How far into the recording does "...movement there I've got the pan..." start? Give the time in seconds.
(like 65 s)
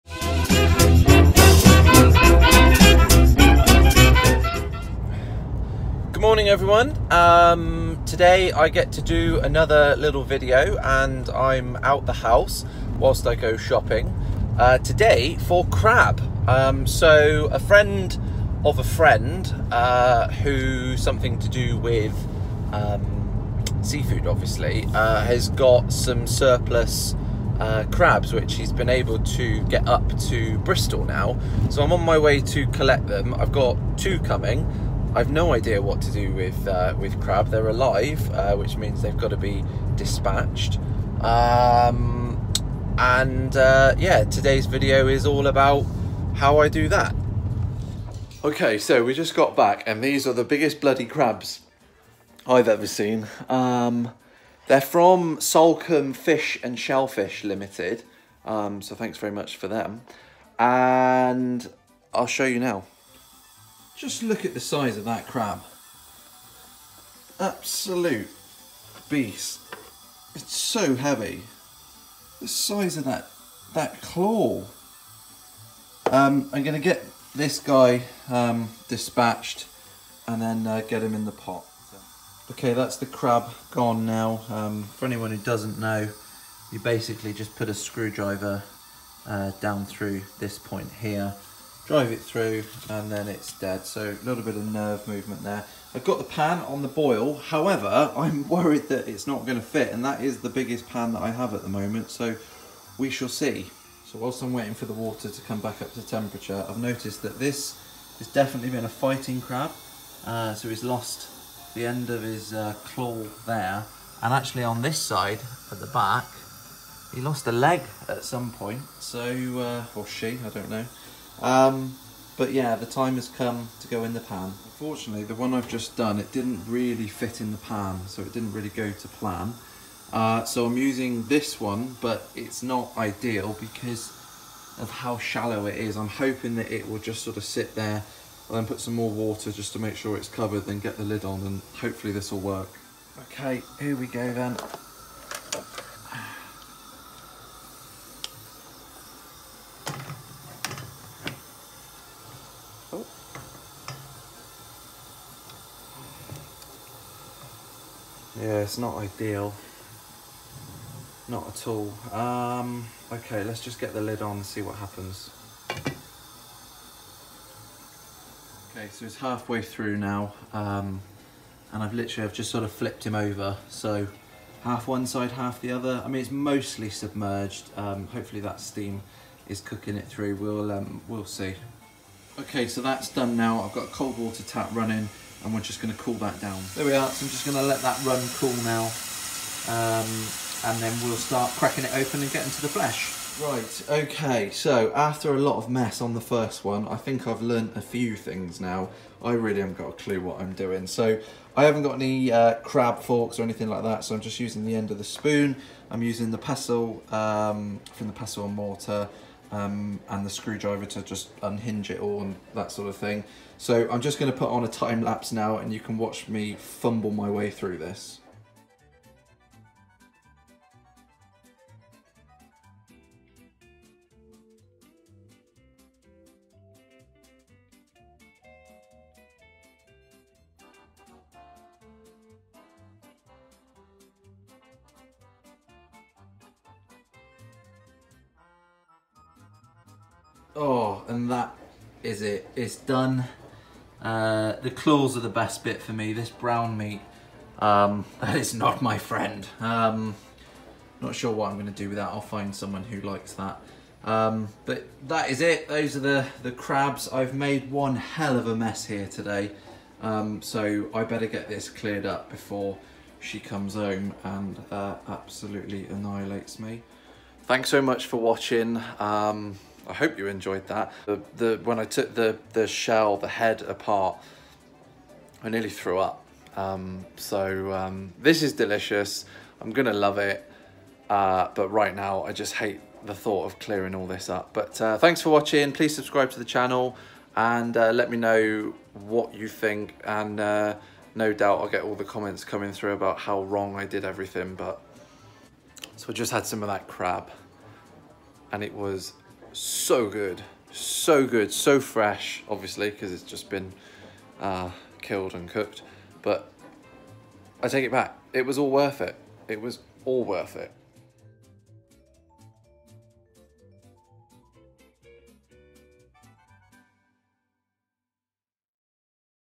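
95 s.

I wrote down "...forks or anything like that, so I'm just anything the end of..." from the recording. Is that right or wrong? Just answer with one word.
wrong.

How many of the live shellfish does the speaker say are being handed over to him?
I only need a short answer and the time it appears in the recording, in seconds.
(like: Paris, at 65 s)
2, at 33 s.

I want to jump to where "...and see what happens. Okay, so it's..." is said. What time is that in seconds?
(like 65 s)
164 s.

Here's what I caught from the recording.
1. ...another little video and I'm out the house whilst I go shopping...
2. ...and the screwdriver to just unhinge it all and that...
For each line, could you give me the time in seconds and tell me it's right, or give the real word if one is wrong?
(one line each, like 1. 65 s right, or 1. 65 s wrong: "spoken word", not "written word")
1. 9 s right
2. 210 s right.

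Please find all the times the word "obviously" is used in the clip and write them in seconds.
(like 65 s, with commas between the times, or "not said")
24 s, 302 s.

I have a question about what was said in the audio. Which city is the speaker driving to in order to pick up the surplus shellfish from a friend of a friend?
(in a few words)
Bristol.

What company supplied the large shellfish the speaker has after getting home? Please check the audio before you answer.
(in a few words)
Salcombe Fish and Shellfish Limited.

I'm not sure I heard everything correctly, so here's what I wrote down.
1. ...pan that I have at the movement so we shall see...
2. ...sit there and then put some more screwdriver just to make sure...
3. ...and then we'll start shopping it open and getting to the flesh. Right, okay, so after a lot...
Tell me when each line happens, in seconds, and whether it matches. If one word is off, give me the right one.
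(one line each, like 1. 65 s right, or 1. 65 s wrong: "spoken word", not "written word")
1. 100 s wrong: "moment", not "movement"
2. 137 s wrong: "water", not "screwdriver"
3. 190 s wrong: "cracking", not "shopping".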